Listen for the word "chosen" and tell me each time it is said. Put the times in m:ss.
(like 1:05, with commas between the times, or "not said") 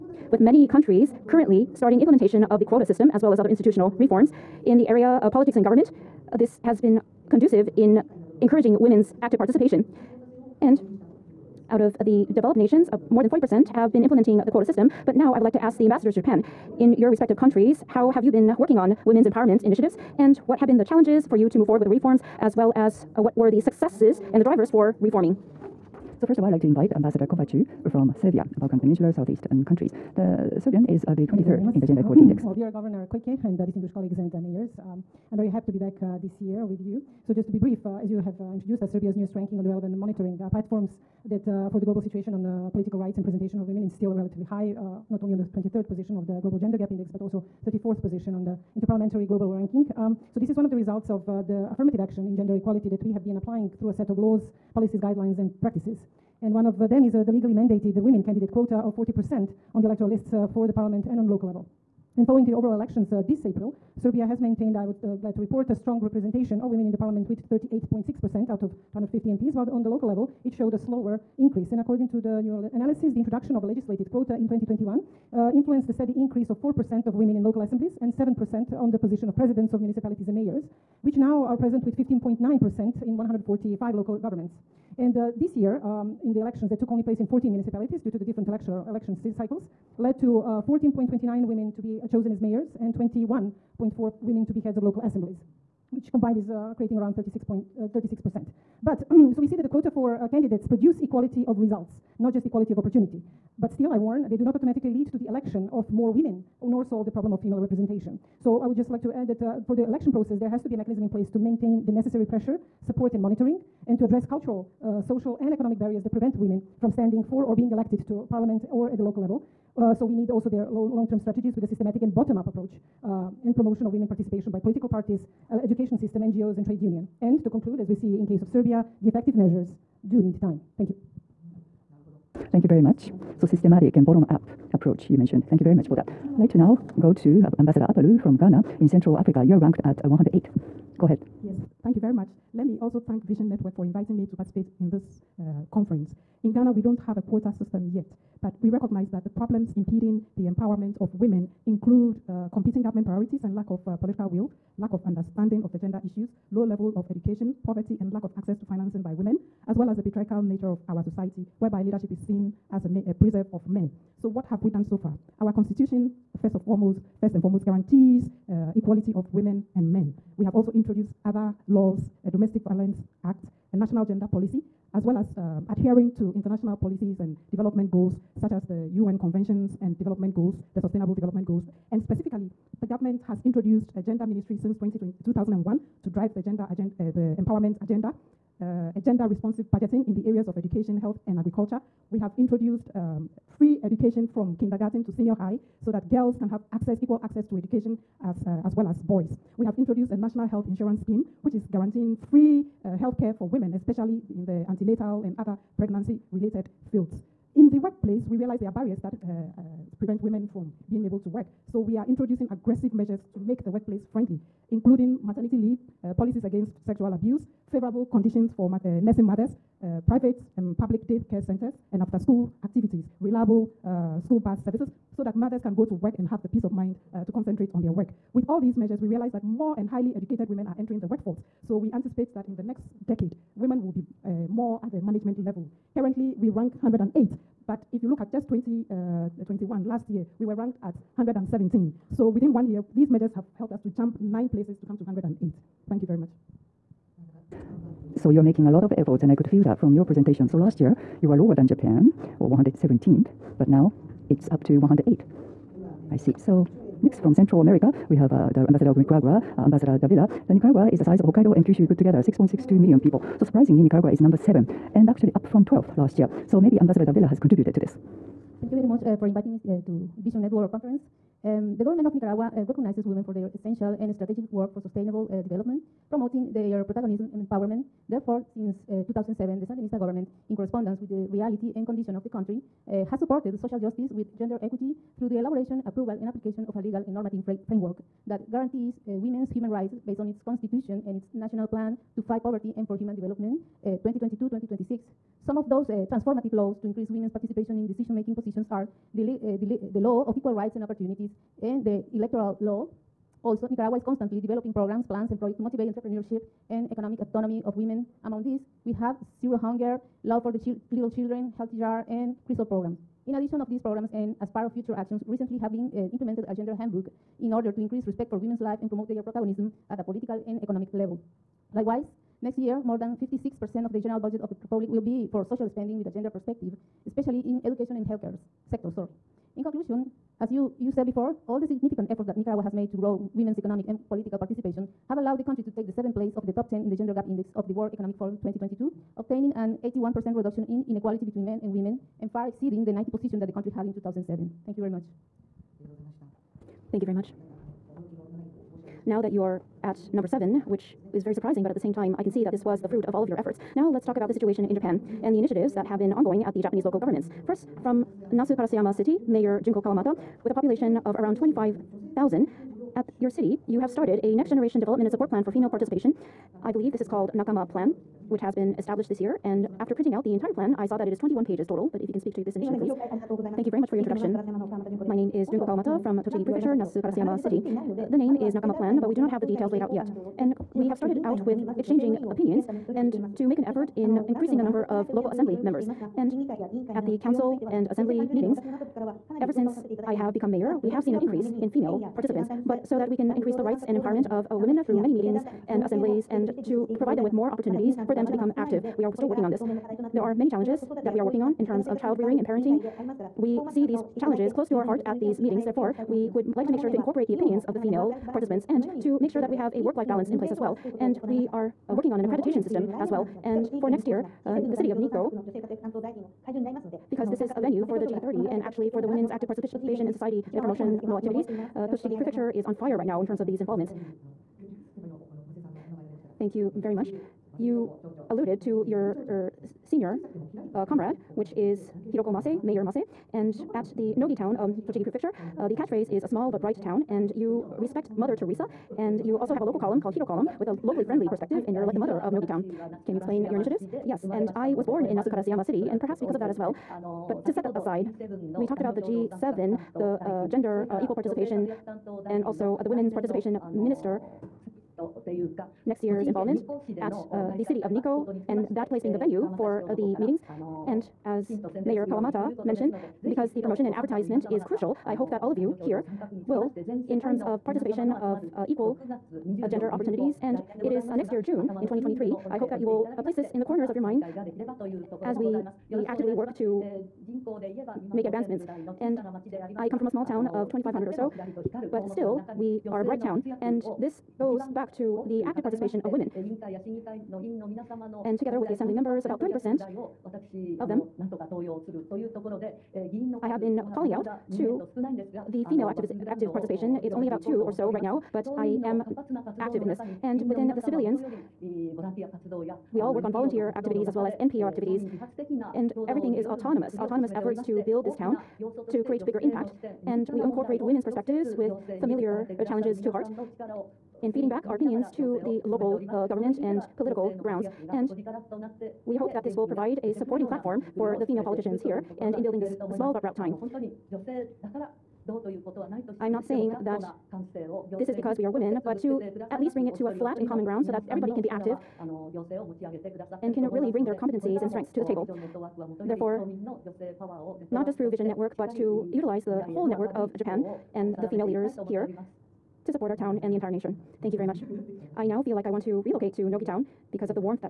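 1:32.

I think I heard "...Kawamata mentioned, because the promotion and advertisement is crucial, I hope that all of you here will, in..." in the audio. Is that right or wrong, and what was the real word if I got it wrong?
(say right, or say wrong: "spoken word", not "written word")
right.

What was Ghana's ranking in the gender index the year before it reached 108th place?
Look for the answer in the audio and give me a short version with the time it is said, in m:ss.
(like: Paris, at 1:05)
117, at 4:01.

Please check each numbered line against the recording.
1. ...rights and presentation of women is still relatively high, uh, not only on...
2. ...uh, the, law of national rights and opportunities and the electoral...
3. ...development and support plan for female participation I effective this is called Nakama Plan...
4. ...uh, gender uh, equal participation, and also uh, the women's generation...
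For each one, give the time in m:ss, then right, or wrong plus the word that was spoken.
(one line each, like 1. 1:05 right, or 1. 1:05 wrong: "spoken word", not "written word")
1. 0:42 right
2. 4:59 wrong: "equal", not "national"
3. 6:04 wrong: "believe", not "effective"
4. 7:30 wrong: "participation", not "generation".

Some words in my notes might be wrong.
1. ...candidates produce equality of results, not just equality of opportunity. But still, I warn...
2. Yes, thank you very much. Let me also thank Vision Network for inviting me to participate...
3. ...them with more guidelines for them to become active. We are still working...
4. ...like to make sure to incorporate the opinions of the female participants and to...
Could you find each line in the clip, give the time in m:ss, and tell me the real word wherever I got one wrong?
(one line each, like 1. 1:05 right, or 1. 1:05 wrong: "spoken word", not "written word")
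1. 1:40 right
2. 2:21 right
3. 6:37 wrong: "opportunities", not "guidelines"
4. 6:46 right.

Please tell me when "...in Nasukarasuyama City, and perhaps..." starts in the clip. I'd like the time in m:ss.
7:25.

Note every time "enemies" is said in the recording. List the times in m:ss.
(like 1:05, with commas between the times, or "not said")
not said.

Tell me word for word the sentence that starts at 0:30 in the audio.
The Serbian is uh, the 23rd in the Gender Equality Index.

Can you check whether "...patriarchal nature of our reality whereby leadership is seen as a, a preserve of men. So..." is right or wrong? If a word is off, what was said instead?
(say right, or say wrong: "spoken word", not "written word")
wrong: "society", not "reality".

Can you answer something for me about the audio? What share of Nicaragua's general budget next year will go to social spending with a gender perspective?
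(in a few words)
more than 56%.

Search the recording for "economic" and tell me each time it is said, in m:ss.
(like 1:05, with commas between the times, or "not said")
1:55, 5:06, 5:20, 5:33, 5:37.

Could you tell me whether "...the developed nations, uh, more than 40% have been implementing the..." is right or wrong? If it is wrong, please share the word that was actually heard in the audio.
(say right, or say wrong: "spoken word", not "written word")
right.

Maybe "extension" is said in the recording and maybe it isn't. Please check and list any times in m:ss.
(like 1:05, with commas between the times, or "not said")
not said.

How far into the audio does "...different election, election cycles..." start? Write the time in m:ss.
1:28.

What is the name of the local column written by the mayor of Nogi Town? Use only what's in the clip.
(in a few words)
Hiro Column.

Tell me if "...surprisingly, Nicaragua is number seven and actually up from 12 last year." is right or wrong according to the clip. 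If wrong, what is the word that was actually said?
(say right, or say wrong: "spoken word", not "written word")
right.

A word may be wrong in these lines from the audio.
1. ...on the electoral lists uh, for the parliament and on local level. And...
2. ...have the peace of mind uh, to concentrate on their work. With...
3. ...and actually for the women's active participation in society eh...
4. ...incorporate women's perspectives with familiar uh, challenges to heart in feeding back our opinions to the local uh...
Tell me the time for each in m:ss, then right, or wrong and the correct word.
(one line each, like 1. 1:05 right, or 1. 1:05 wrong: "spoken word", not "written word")
1. 0:59 right
2. 3:46 right
3. 6:58 right
4. 8:30 right.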